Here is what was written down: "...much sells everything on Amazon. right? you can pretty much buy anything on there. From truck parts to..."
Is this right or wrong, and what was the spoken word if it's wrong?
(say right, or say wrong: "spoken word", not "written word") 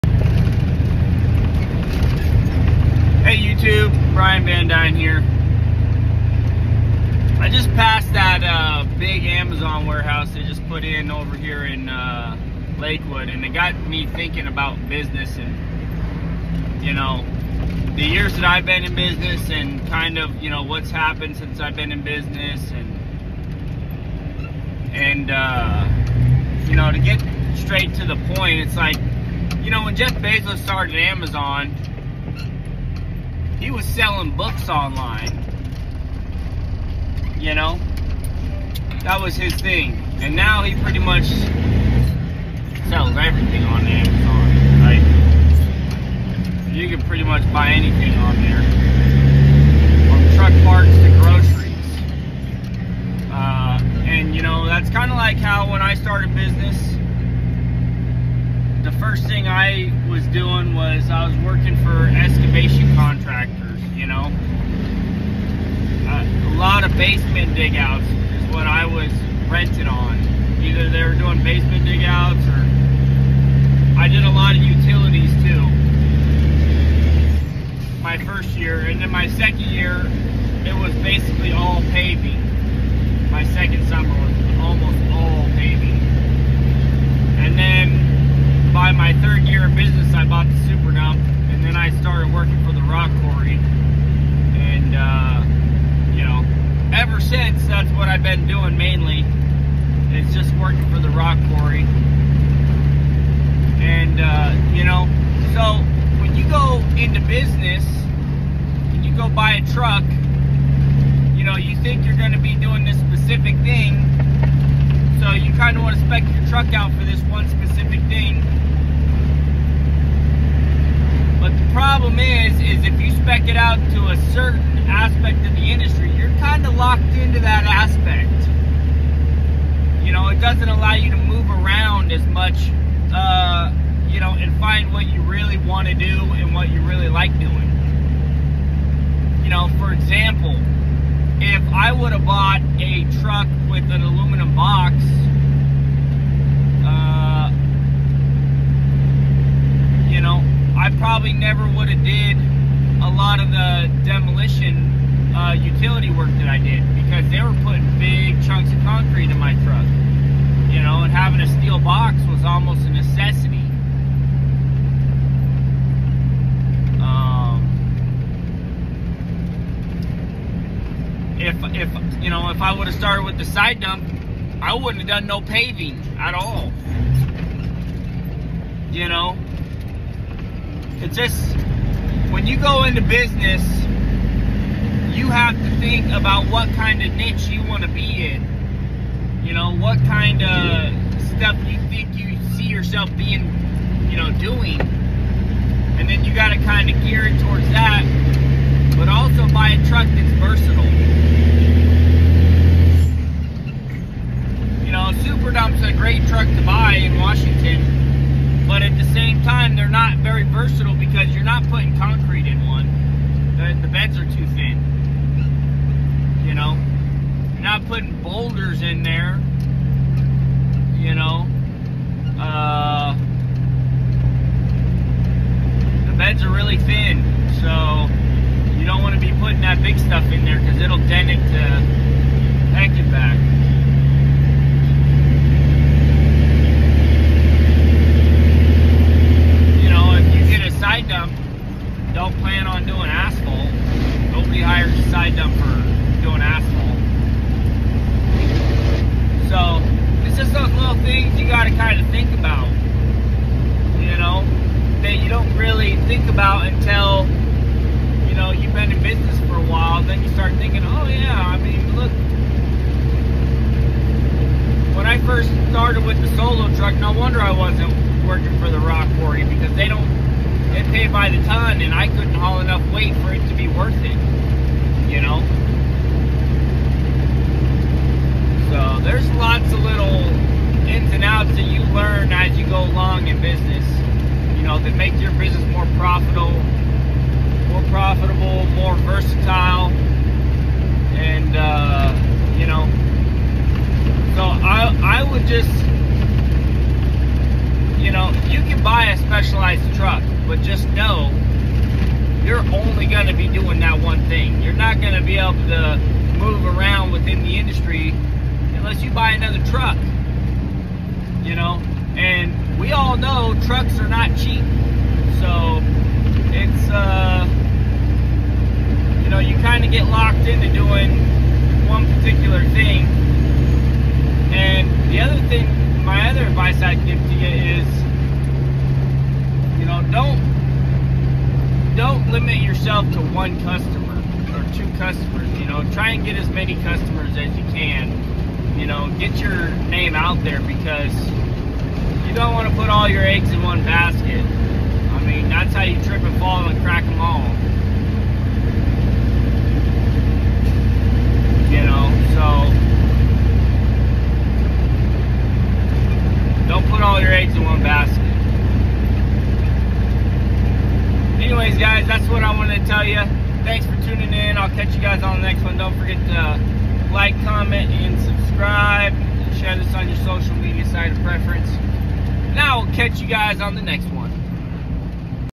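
right.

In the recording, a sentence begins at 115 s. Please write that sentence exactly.
So you kind of want to spec your truck out for this one specific thing.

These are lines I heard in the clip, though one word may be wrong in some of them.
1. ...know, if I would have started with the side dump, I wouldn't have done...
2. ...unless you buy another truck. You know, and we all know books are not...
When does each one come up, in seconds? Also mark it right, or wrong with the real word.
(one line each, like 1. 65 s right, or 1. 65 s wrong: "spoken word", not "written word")
1. 172 s right
2. 308 s wrong: "trucks", not "books".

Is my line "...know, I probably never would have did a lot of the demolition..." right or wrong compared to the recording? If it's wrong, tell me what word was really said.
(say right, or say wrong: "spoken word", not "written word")
right.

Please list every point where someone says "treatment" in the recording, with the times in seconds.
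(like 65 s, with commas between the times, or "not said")
not said.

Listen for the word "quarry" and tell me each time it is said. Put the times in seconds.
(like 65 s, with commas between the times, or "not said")
101 s, 269 s.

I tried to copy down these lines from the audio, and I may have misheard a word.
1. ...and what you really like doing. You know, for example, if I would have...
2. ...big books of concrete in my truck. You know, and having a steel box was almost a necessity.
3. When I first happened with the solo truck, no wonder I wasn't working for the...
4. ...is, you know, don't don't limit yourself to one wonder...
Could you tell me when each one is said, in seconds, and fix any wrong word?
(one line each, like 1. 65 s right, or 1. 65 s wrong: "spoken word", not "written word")
1. 136 s right
2. 157 s wrong: "chunks", not "books"
3. 264 s wrong: "started", not "happened"
4. 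327 s wrong: "customer", not "wonder".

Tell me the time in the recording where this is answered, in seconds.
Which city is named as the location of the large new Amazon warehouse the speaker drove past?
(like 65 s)
12 s.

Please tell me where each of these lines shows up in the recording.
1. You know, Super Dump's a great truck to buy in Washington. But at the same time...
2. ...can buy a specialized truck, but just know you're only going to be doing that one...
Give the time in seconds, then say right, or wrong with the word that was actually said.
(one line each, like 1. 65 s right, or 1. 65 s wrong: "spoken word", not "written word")
1. 204 s right
2. 298 s right.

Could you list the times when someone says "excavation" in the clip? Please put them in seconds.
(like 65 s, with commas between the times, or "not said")
62 s.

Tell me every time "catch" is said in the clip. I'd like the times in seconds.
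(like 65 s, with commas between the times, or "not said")
364 s, 372 s.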